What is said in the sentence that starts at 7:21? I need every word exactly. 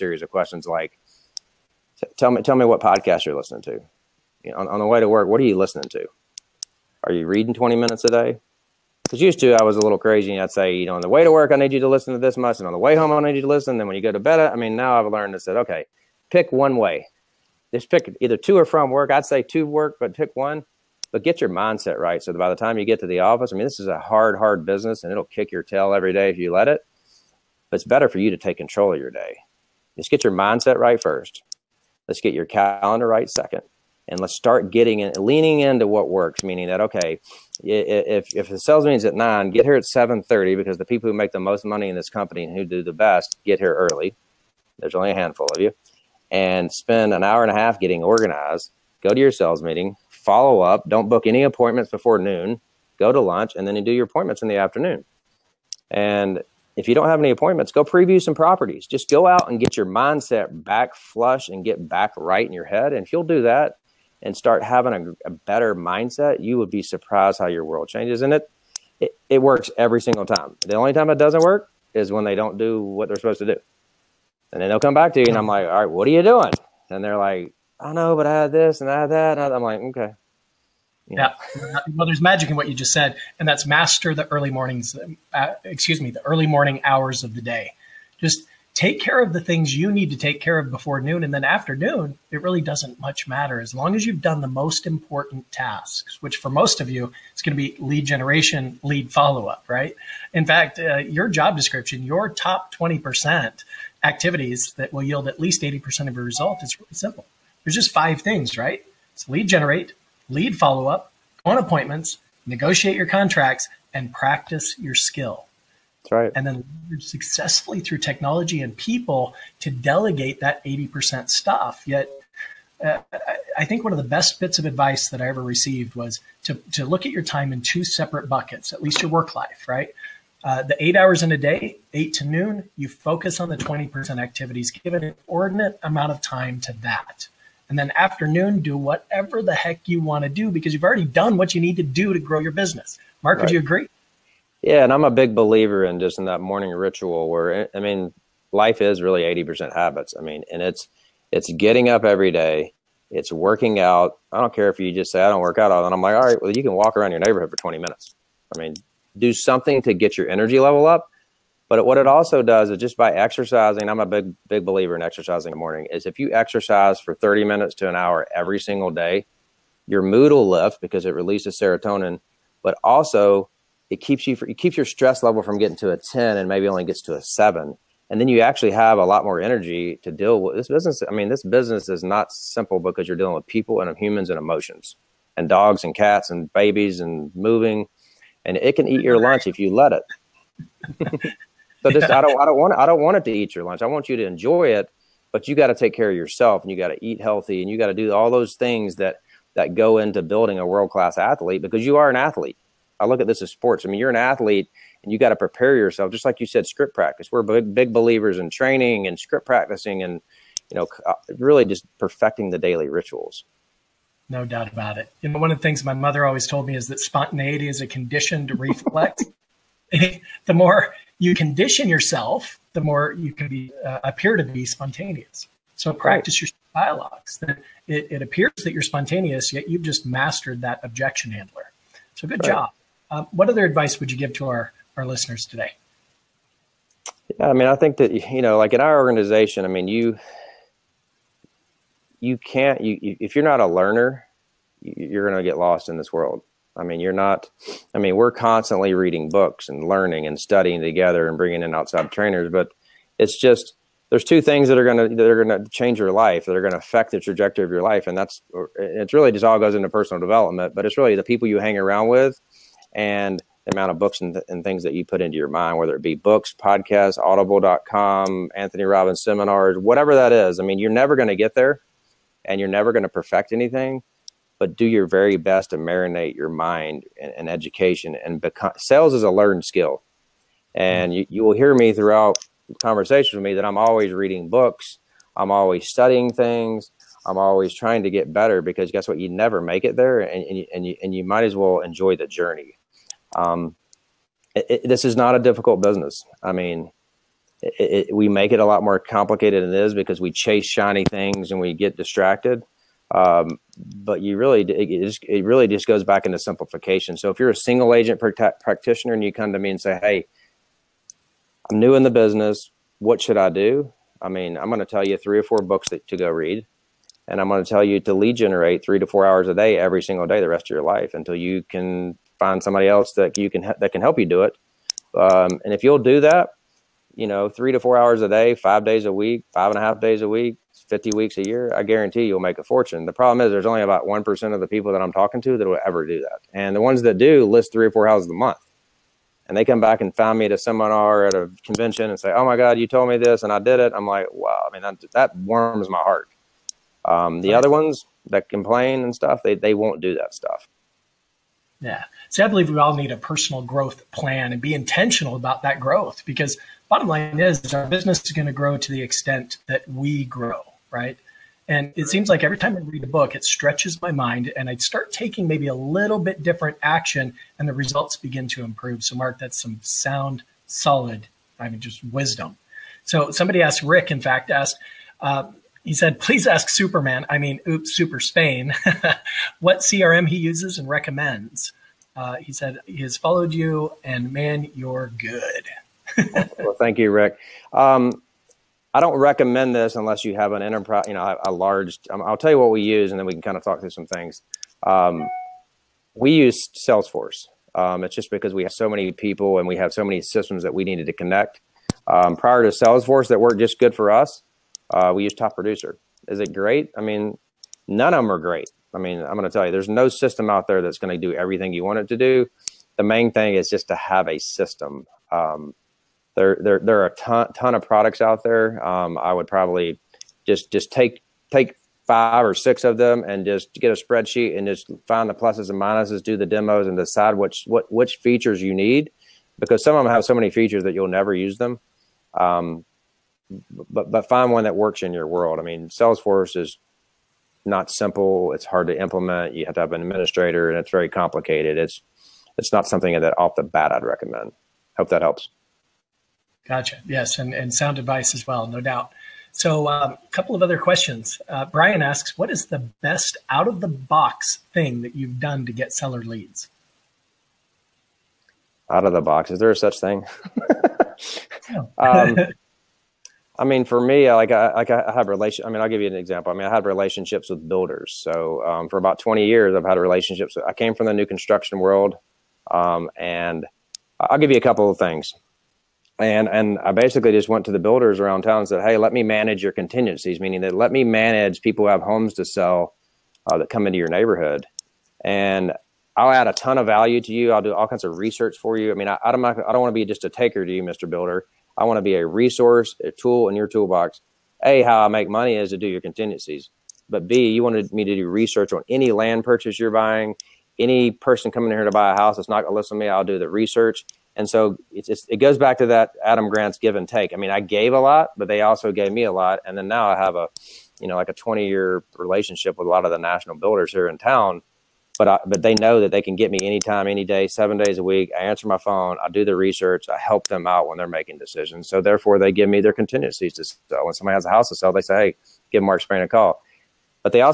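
It's it's not something that off the bat I'd recommend.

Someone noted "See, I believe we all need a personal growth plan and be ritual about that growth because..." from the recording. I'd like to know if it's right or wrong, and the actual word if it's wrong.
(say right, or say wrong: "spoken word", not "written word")
wrong: "intentional", not "ritual".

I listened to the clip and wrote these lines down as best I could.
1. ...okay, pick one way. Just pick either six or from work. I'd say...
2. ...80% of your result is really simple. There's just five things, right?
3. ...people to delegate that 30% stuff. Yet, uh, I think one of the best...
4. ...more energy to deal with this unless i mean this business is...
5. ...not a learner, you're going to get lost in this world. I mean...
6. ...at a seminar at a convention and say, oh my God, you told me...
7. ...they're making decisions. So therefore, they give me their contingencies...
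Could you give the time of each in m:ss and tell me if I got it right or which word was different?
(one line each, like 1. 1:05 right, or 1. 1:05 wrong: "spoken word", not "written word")
1. 0:15 wrong: "two", not "six"
2. 1:45 right
3. 1:58 wrong: "80", not "30"
4. 2:59 wrong: "business", not "unless"
5. 4:03 right
6. 5:40 right
7. 8:40 right.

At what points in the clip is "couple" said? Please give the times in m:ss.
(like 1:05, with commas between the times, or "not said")
7:30, 7:54.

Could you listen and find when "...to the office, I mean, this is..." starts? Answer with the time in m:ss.
0:23.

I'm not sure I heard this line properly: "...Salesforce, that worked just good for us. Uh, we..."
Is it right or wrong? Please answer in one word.
right.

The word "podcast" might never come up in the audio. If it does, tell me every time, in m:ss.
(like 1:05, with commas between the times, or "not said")
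0:02, 4:26.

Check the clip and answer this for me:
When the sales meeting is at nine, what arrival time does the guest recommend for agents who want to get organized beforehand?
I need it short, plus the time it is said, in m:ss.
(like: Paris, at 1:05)
7:30, at 0:39.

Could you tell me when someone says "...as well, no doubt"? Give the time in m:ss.
7:28.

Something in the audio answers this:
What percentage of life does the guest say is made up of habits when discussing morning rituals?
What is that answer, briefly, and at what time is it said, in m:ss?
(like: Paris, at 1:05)
80%, at 2:29.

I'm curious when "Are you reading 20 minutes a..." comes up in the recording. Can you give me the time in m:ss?
0:07.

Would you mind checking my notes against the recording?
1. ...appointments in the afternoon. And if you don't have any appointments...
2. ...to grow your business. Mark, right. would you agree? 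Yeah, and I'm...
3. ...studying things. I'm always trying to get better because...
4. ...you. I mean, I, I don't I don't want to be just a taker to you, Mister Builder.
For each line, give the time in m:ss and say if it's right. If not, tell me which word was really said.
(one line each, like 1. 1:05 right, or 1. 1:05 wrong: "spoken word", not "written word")
1. 0:54 right
2. 2:22 right
3. 4:45 right
4. 8:08 right.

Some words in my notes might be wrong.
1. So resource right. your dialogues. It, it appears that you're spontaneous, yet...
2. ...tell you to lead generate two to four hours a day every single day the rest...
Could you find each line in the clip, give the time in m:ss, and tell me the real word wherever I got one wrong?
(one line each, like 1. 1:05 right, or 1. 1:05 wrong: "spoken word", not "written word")
1. 3:45 wrong: "practice", not "resource"
2. 5:17 wrong: "three", not "two".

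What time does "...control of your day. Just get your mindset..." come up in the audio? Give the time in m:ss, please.
0:28.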